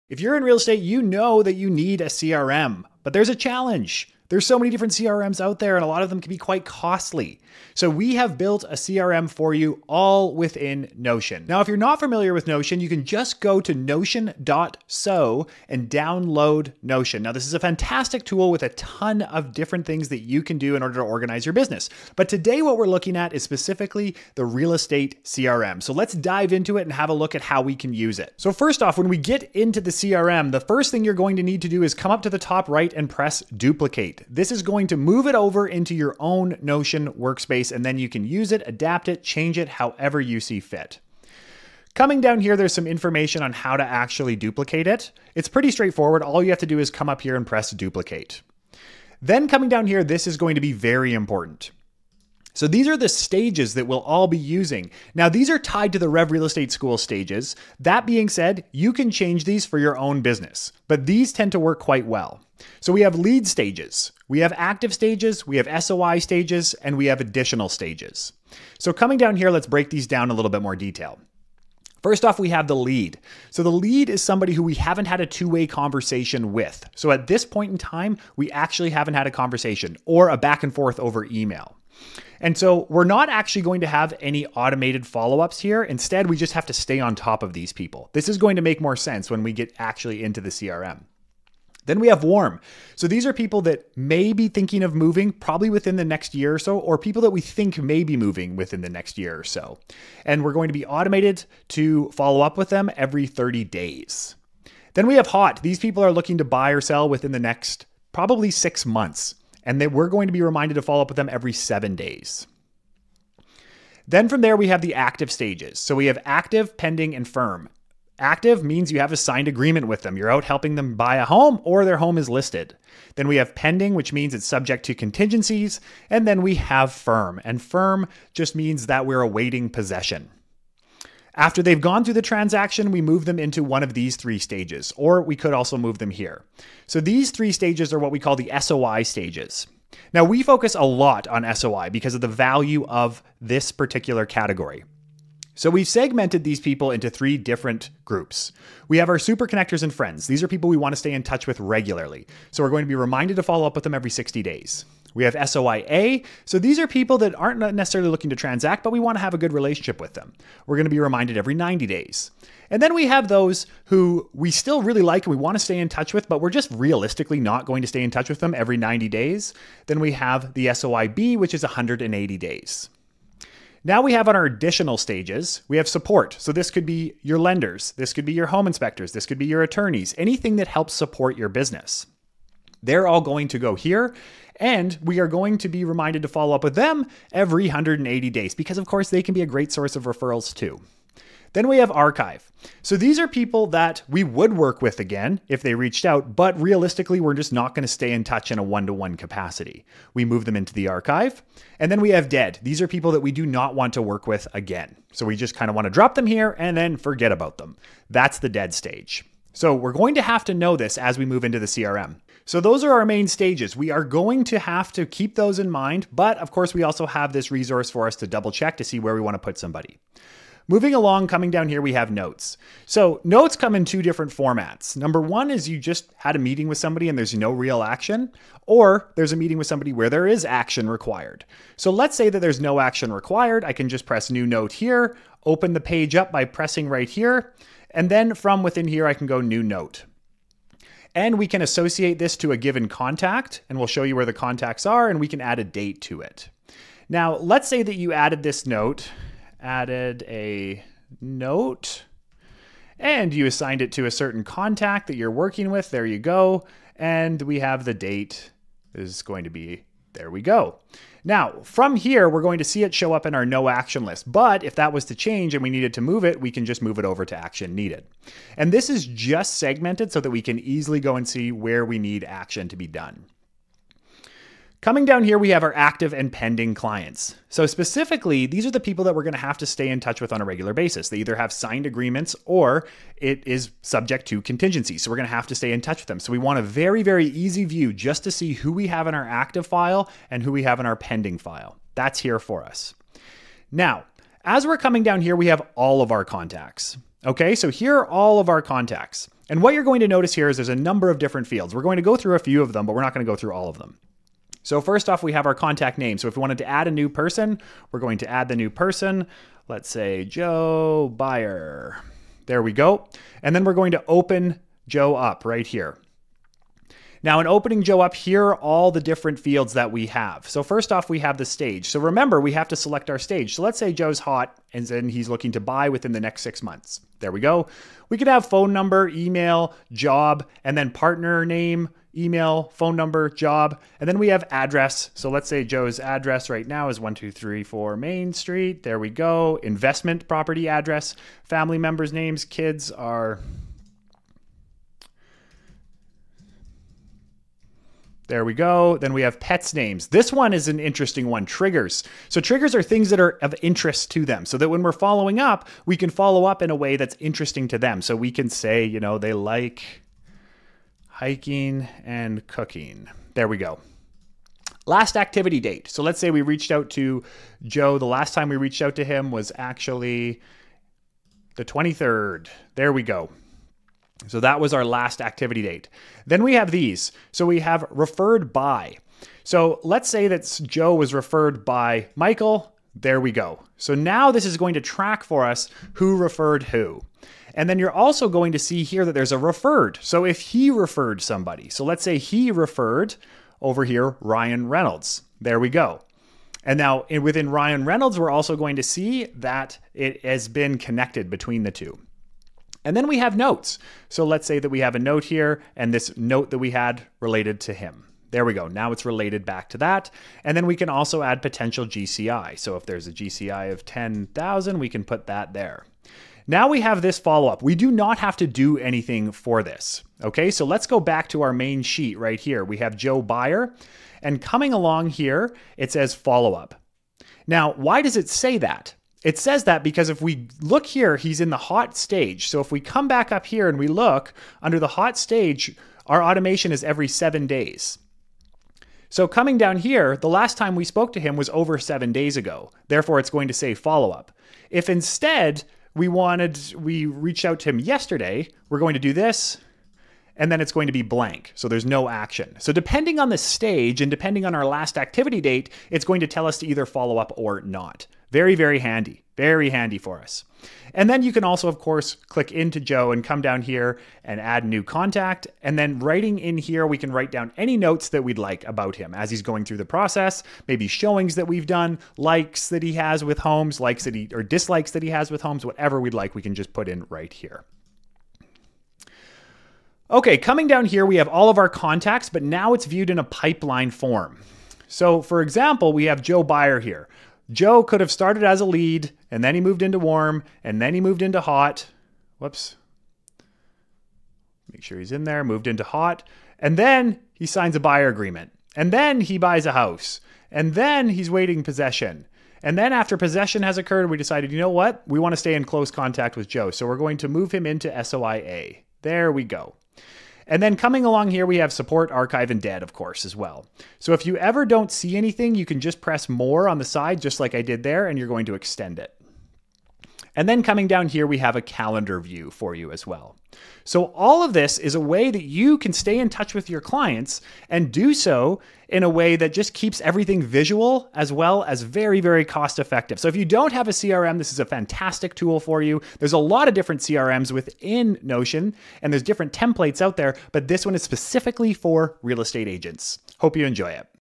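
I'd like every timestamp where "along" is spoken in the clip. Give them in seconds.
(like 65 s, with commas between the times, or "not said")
220 s, 424 s, 511 s.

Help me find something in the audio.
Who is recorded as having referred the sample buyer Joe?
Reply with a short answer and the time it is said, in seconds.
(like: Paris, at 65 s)
Michael, at 382 s.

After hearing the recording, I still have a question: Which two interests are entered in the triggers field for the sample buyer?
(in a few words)
hiking and cooking.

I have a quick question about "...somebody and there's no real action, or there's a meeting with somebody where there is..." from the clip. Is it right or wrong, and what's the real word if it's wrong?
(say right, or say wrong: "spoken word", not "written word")
right.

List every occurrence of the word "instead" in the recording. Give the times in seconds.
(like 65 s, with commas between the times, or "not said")
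85 s, 444 s.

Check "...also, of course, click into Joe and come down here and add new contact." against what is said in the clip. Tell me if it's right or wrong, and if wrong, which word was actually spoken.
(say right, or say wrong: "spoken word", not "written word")
right.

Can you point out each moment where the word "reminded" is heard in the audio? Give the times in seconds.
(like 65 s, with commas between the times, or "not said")
110 s, 152 s, 160 s, 185 s.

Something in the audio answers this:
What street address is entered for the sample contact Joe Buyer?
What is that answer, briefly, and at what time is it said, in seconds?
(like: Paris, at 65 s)
1234 Main Street, at 336 s.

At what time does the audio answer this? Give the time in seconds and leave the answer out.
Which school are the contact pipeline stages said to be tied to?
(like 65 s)
56 s.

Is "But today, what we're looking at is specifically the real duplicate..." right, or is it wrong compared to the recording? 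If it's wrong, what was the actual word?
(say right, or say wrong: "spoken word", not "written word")
wrong: "estate", not "duplicate".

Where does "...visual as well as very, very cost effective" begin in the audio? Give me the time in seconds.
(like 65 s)
530 s.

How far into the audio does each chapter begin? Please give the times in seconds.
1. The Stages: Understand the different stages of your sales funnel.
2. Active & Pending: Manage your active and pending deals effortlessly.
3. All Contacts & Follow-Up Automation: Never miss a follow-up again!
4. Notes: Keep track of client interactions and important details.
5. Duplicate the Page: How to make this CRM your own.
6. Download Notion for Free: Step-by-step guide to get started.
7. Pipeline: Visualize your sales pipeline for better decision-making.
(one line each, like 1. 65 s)
1. 53 s
2. 274 s
3. 294 s
4. 220 s
5. 28 s
6. 13 s
7. 480 s.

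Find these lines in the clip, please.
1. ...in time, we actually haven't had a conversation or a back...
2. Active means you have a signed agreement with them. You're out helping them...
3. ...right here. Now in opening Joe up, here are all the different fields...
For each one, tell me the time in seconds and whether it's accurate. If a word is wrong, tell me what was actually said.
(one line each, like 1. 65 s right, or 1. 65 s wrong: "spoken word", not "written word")
1. 77 s right
2. 118 s right
3. 315 s right.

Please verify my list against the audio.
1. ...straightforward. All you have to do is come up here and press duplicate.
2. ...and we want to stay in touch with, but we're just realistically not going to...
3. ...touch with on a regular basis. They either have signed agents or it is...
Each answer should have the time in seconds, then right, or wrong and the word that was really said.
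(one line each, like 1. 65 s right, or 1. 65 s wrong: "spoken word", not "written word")
1. 45 s right
2. 165 s right
3. 279 s wrong: "agreements", not "agents".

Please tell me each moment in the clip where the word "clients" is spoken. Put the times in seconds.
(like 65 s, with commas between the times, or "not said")
276 s, 526 s.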